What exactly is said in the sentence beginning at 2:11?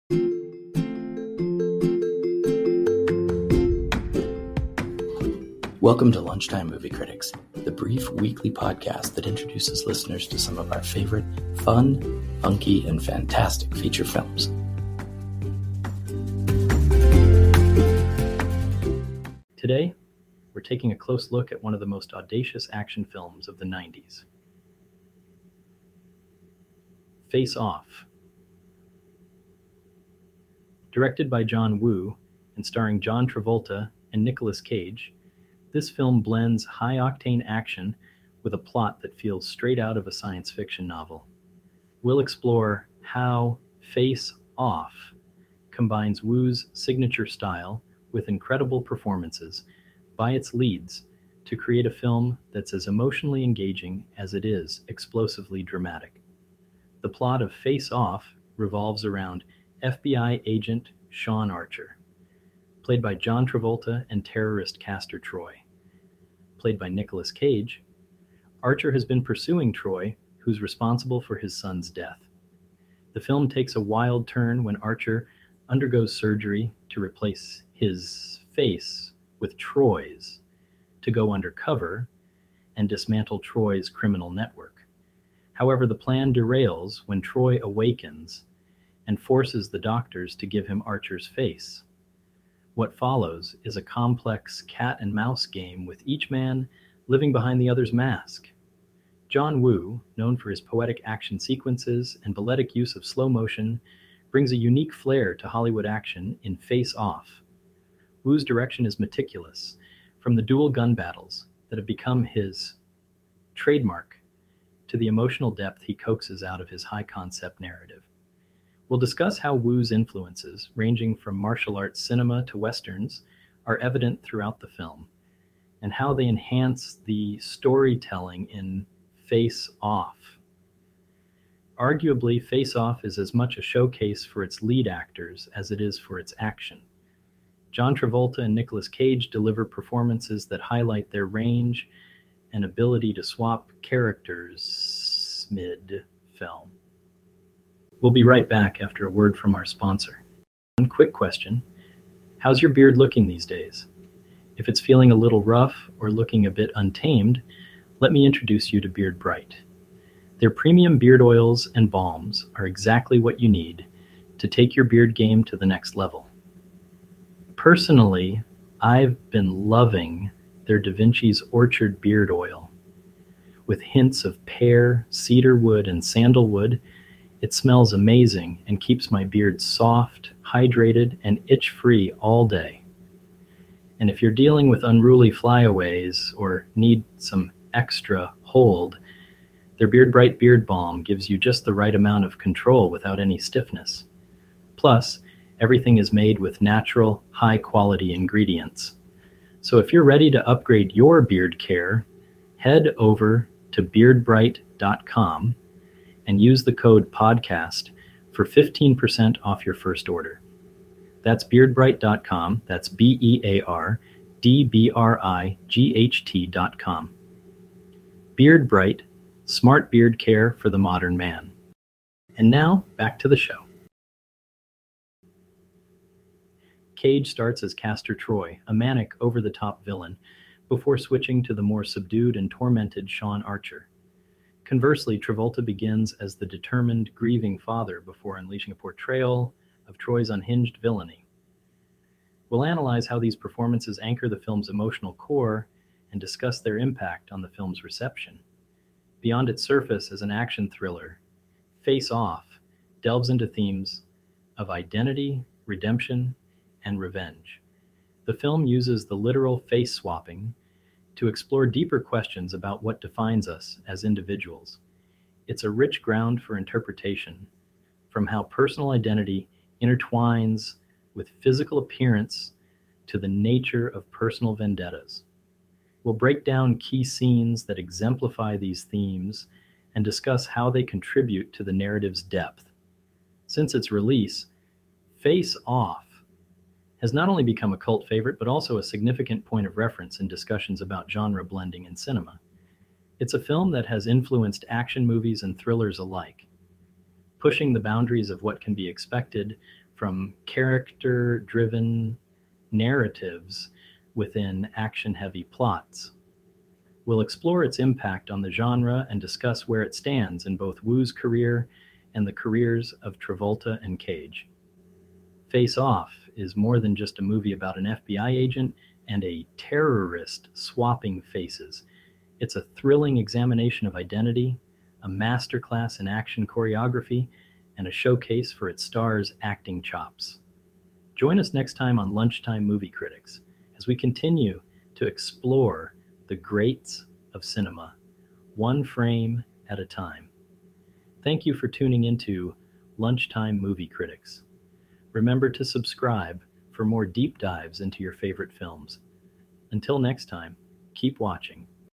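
Arguably, Face Off is as much a showcase for its lead actors as it is for its action.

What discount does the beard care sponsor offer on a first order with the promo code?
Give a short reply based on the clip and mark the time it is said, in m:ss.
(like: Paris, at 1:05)
15%, at 3:28.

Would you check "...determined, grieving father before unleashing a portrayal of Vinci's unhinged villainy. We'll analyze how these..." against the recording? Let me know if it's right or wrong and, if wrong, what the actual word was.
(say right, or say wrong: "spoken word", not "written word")
wrong: "Troy", not "Vinci".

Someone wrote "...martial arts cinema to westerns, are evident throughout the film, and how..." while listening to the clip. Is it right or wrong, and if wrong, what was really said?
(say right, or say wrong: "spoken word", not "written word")
right.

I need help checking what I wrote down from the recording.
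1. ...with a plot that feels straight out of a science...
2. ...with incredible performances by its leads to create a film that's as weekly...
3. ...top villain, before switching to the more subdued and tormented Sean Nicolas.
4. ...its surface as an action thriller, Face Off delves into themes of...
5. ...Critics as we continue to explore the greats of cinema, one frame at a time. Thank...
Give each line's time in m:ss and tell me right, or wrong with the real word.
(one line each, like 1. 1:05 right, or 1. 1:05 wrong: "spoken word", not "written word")
1. 0:38 right
2. 0:48 wrong: "emotionally", not "weekly"
3. 3:49 wrong: "Archer", not "Nicolas"
4. 4:09 right
5. 5:32 right.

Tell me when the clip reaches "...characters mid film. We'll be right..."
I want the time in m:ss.
2:23.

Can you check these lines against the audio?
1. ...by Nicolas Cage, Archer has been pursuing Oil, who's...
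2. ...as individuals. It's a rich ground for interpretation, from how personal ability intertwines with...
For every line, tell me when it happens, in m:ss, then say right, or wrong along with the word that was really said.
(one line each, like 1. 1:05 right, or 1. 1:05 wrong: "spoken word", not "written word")
1. 1:06 wrong: "Troy", not "Oil"
2. 4:23 wrong: "identity", not "ability".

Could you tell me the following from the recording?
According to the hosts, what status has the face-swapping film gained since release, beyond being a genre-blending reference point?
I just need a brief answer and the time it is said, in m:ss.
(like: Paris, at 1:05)
cult favorite, at 4:47.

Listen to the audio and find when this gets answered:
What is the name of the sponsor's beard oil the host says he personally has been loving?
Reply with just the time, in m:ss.
2:50.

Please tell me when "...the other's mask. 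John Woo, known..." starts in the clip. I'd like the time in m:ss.
1:37.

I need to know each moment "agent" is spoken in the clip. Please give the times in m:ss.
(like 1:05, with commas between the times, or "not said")
1:00, 5:18.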